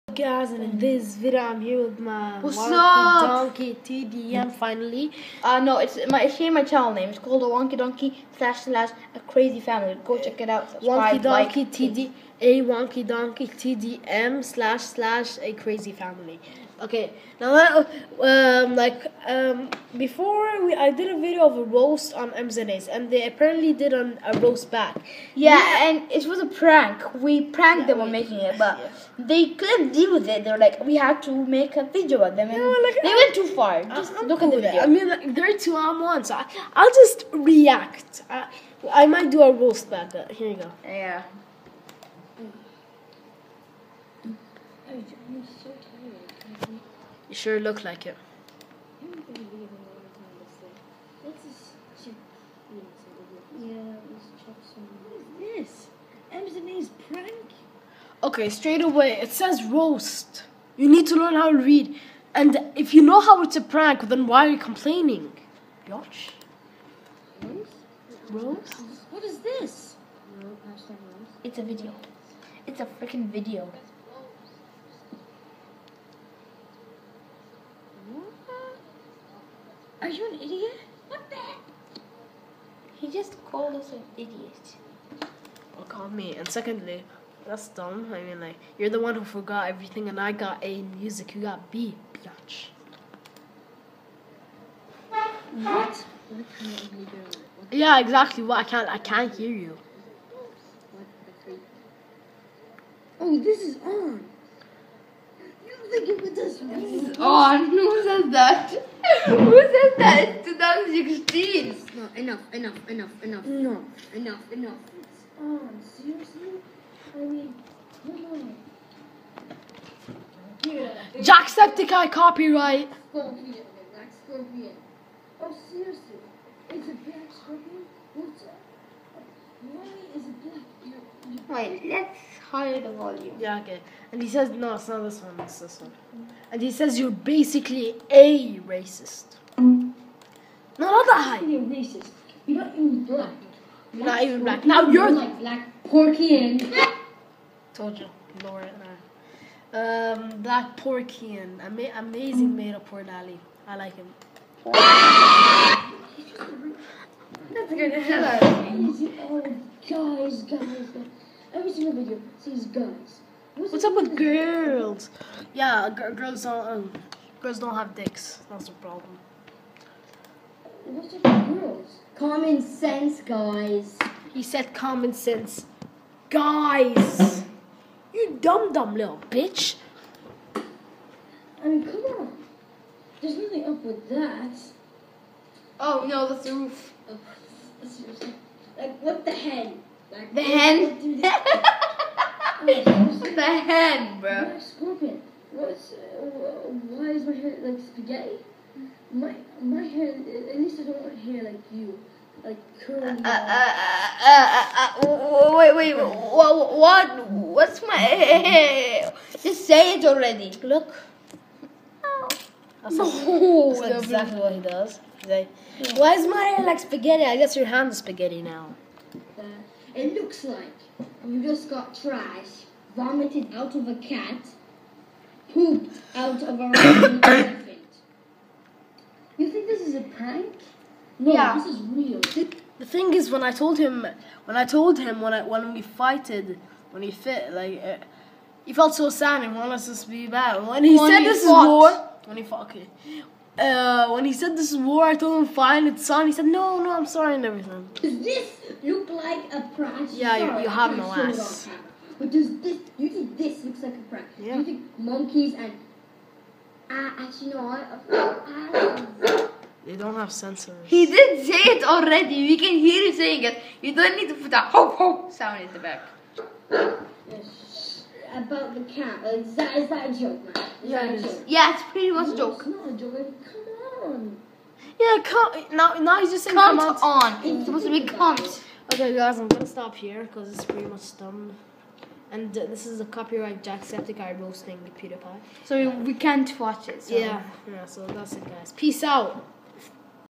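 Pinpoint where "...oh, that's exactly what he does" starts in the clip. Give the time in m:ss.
3:33.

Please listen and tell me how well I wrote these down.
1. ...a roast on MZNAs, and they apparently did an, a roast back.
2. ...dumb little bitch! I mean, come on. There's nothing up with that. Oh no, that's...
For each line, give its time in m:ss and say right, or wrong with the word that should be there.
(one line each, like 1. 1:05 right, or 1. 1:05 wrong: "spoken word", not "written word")
1. 0:21 right
2. 2:58 right.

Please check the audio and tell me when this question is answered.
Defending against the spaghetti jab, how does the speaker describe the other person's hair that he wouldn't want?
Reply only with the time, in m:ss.
3:22.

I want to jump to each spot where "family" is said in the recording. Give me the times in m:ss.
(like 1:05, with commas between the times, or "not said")
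0:09, 0:15.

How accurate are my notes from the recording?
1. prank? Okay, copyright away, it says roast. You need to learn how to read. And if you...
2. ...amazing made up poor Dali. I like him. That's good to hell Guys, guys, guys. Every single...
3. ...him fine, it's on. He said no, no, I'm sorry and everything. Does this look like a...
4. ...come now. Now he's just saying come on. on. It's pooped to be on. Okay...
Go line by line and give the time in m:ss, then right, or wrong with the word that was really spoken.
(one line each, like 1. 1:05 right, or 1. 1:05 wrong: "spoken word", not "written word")
1. 0:57 wrong: "straight", not "copyright"
2. 2:31 right
3. 4:05 right
4. 4:35 wrong: "supposed", not "pooped".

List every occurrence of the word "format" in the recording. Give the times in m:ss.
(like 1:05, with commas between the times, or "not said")
not said.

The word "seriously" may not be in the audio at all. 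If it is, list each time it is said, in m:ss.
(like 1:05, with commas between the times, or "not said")
1:55, 2:05.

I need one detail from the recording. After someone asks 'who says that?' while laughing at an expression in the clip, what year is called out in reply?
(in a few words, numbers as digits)
2016.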